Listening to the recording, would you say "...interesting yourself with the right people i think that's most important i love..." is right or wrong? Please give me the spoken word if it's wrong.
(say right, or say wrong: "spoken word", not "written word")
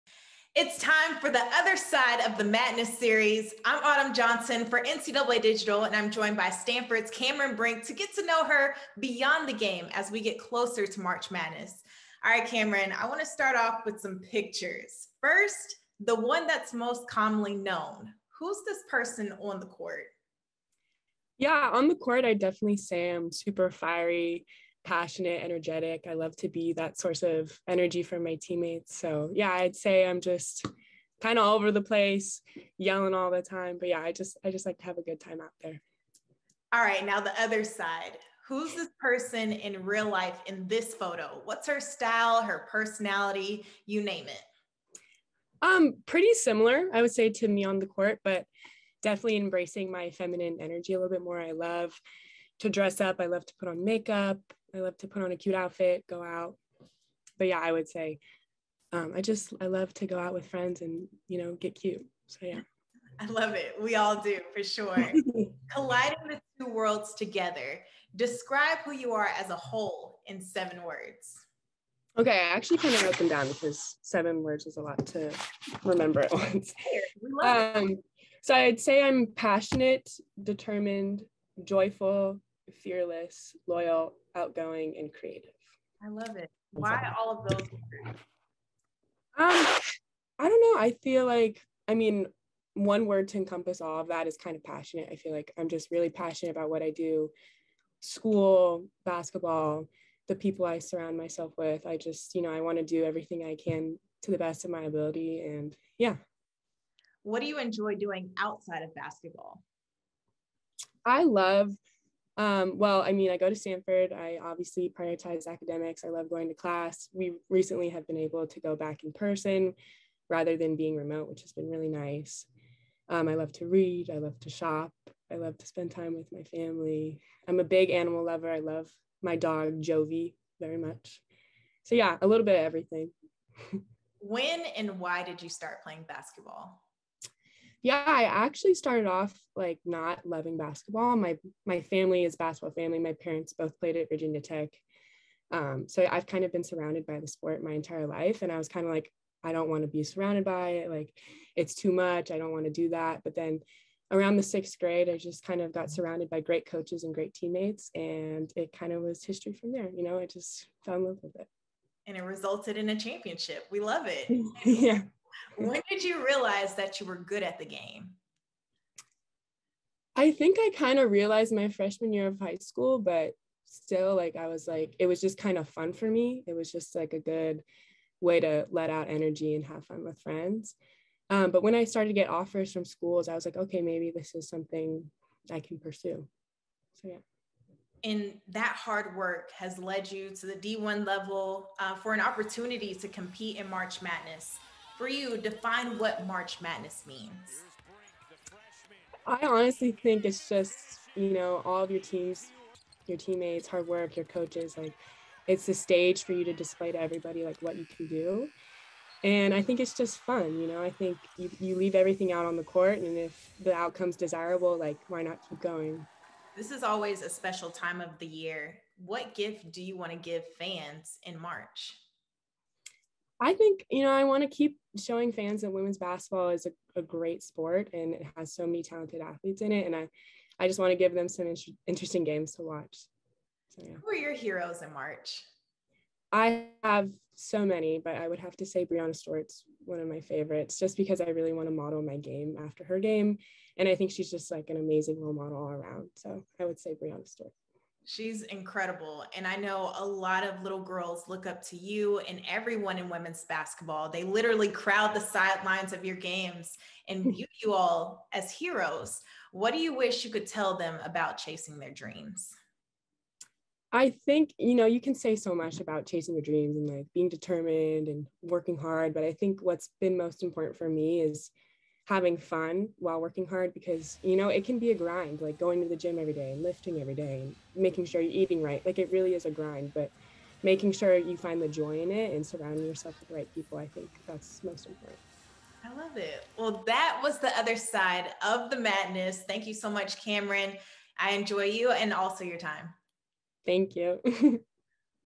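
wrong: "surrounding", not "interesting".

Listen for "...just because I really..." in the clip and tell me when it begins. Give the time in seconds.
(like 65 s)
240 s.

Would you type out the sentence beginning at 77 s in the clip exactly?
Um, so I'd say I'm passionate, determined, joyful, fearless, loyal, outgoing, and creative.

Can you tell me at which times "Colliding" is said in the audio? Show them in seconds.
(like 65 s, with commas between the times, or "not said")
65 s.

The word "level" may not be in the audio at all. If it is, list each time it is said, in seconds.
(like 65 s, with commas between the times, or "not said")
191 s.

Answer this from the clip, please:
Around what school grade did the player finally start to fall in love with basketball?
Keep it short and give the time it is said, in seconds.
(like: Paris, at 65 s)
Sixth grade, at 154 s.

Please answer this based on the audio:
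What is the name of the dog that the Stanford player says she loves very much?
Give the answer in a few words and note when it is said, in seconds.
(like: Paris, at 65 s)
Jovi, at 129 s.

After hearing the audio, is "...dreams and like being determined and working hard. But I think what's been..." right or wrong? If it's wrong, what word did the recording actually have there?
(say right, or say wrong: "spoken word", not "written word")
right.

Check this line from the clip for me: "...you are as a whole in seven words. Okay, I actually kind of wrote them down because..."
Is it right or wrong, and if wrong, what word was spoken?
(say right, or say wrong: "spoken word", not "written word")
right.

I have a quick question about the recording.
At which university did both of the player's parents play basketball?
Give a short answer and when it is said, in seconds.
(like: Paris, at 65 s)
Virginia Tech, at 144 s.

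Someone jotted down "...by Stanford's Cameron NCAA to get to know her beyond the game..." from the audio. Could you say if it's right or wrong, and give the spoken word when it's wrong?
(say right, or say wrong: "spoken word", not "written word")
wrong: "Brink", not "NCAA".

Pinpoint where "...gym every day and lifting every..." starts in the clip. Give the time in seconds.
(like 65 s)
275 s.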